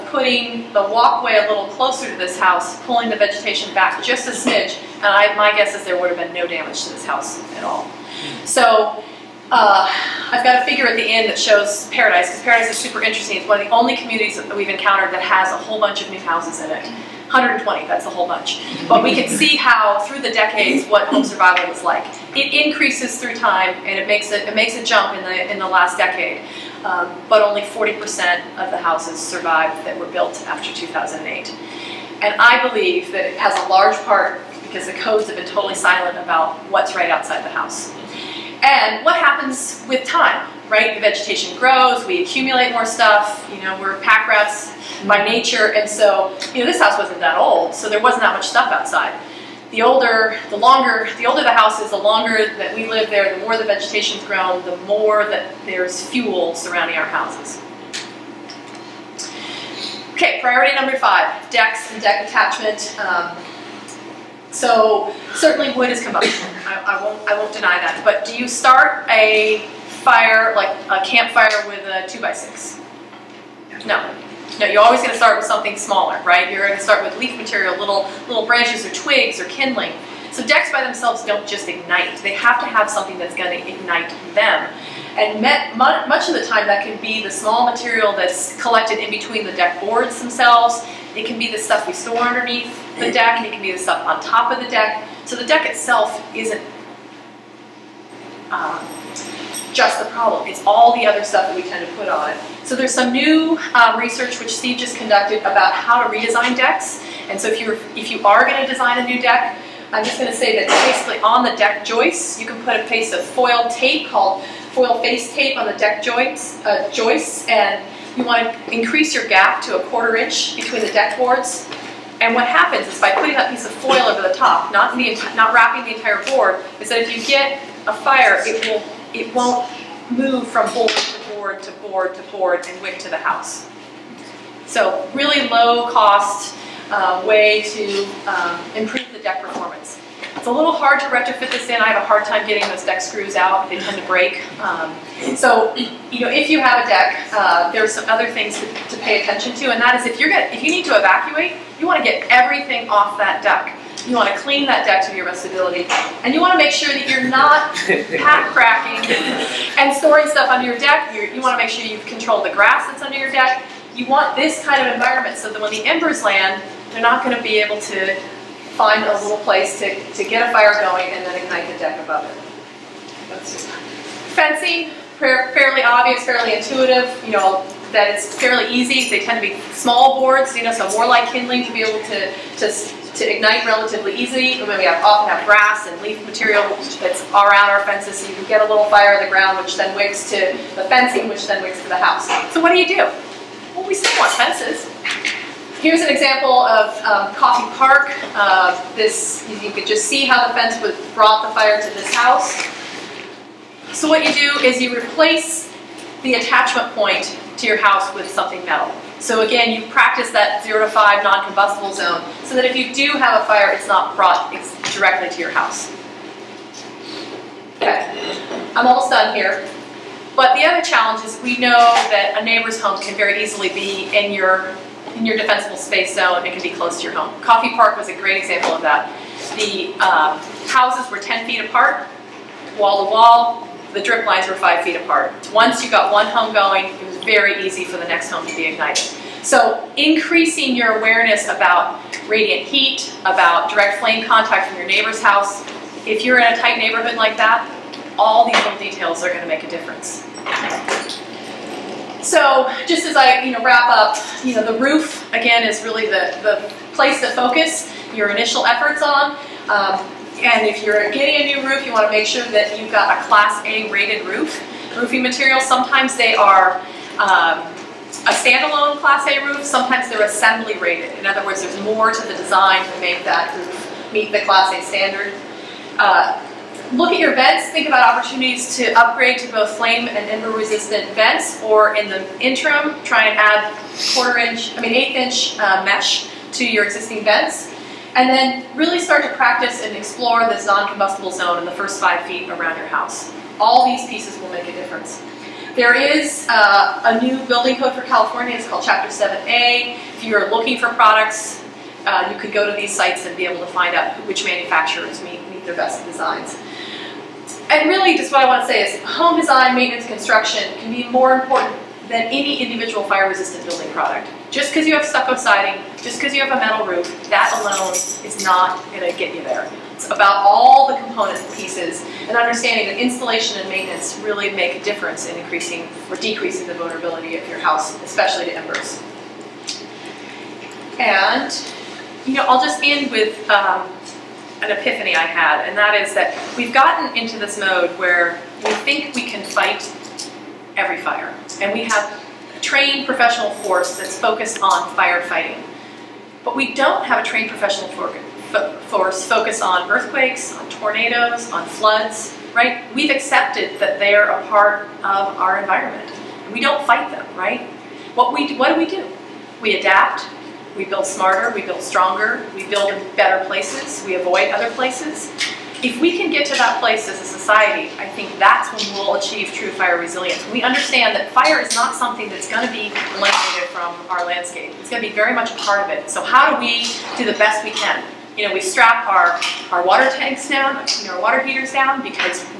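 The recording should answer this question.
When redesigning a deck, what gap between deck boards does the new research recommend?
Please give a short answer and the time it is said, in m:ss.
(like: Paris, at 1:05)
a quarter inch, at 1:59.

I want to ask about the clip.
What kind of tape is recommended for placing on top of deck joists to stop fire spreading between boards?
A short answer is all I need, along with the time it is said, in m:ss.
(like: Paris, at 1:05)
foil face tape, at 1:54.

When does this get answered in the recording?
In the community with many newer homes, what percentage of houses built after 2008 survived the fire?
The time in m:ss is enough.
0:27.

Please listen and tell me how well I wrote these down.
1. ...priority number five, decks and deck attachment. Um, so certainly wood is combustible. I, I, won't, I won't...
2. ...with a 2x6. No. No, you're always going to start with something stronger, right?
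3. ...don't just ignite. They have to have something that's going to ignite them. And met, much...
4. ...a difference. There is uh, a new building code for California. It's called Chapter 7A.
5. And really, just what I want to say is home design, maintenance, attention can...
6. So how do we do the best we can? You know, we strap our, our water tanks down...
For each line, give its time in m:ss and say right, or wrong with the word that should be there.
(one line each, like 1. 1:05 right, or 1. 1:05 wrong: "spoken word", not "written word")
1. 1:00 right
2. 1:11 wrong: "smaller", not "stronger"
3. 1:21 right
4. 4:54 right
5. 5:07 wrong: "construction", not "attention"
6. 6:16 right.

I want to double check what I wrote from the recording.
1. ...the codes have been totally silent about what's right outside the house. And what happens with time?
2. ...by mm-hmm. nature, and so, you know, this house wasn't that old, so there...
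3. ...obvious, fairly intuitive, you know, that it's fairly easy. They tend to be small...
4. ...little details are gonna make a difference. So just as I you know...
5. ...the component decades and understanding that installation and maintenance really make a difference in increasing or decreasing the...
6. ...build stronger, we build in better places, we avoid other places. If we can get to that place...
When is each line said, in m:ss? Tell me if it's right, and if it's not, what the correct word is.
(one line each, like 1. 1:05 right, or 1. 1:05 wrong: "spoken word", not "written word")
1. 0:34 right
2. 0:45 right
3. 2:55 right
4. 4:08 right
5. 5:20 wrong: "pieces", not "decades"
6. 6:01 right.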